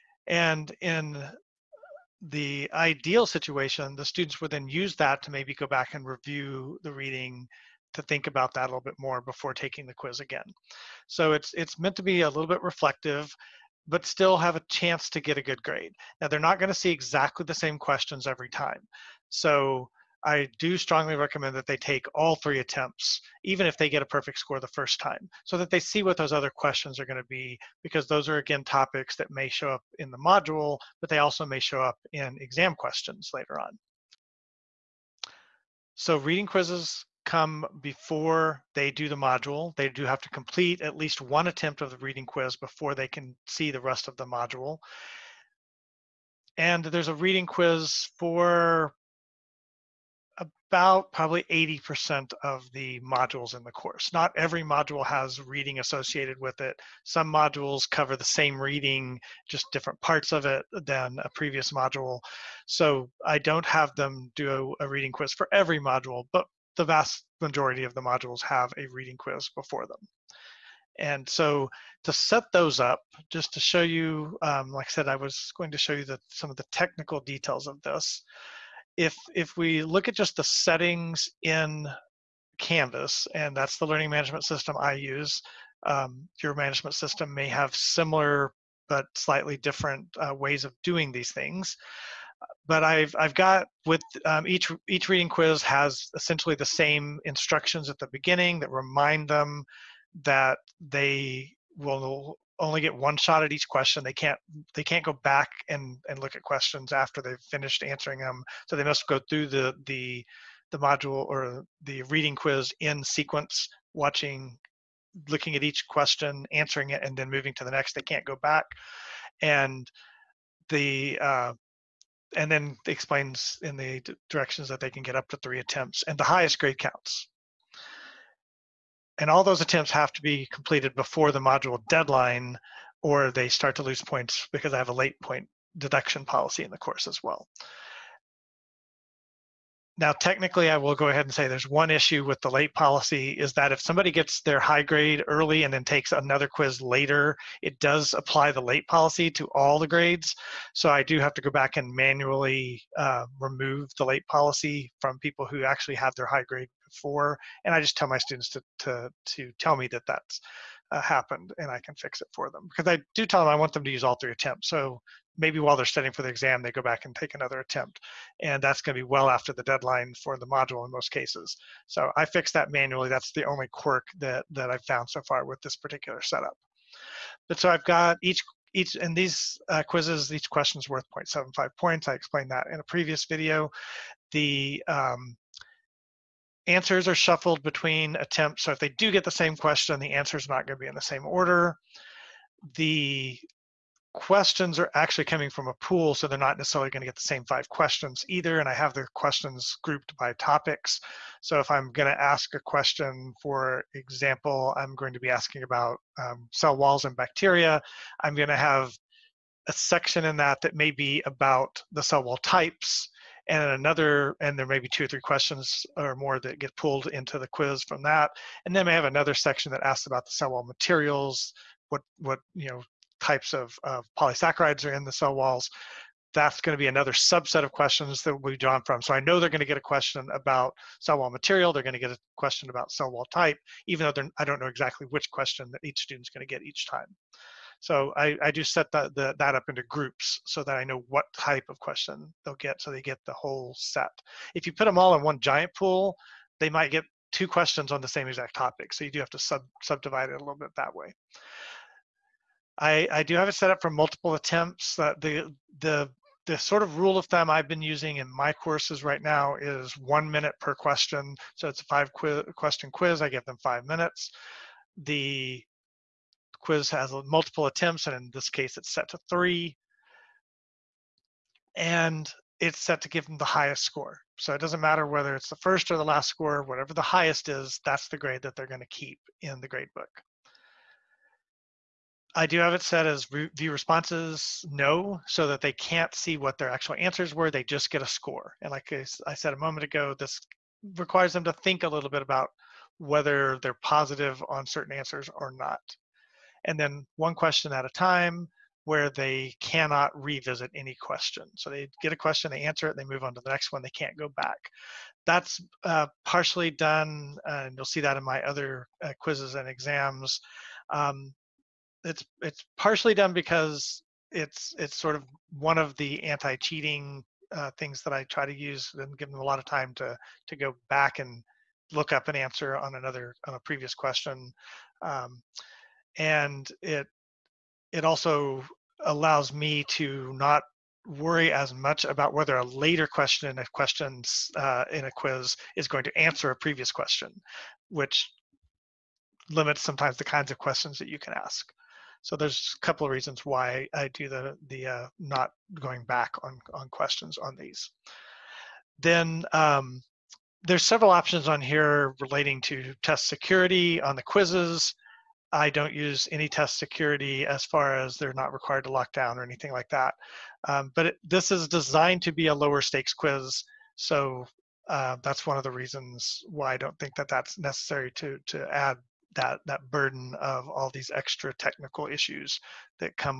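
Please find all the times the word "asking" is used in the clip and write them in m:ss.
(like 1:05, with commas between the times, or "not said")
3:25.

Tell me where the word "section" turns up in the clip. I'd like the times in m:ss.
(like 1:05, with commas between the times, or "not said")
3:29, 3:39.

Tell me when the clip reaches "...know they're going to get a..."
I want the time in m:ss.
3:49.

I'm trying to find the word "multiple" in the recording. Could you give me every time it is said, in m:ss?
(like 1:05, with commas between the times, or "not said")
4:13, 4:27.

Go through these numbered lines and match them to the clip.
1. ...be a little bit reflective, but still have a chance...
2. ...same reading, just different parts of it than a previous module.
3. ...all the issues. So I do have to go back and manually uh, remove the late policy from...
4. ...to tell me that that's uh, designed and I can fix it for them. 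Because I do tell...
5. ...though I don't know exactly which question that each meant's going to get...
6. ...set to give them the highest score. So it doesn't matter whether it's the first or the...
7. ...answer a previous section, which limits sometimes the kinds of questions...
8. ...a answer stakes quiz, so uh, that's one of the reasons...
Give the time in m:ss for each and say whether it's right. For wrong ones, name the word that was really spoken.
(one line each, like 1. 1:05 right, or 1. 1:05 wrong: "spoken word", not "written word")
1. 0:12 right
2. 0:58 right
3. 2:29 wrong: "grades", not "issues"
4. 2:39 wrong: "happened", not "designed"
5. 3:54 wrong: "student", not "meant"
6. 4:32 right
7. 5:36 wrong: "question", not "section"
8. 6:02 wrong: "lower", not "answer".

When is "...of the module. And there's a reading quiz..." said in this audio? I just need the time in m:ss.
0:44.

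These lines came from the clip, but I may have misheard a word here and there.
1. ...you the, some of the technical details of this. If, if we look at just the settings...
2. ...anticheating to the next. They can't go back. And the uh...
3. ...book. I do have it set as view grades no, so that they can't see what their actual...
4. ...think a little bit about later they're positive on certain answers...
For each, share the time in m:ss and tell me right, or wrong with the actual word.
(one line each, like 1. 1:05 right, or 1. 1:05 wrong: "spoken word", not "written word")
1. 1:15 right
2. 1:57 wrong: "moving", not "anticheating"
3. 4:39 wrong: "responses", not "grades"
4. 4:51 wrong: "whether", not "later".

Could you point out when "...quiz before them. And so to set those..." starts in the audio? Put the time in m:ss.
1:09.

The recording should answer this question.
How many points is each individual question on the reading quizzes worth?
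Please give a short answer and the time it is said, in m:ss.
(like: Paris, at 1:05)
0.75, at 3:01.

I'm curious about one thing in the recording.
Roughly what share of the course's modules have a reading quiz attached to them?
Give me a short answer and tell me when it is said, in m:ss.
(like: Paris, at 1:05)
80%, at 0:51.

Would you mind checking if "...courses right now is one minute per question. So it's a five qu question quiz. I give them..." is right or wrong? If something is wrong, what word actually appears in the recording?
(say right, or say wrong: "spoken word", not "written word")
right.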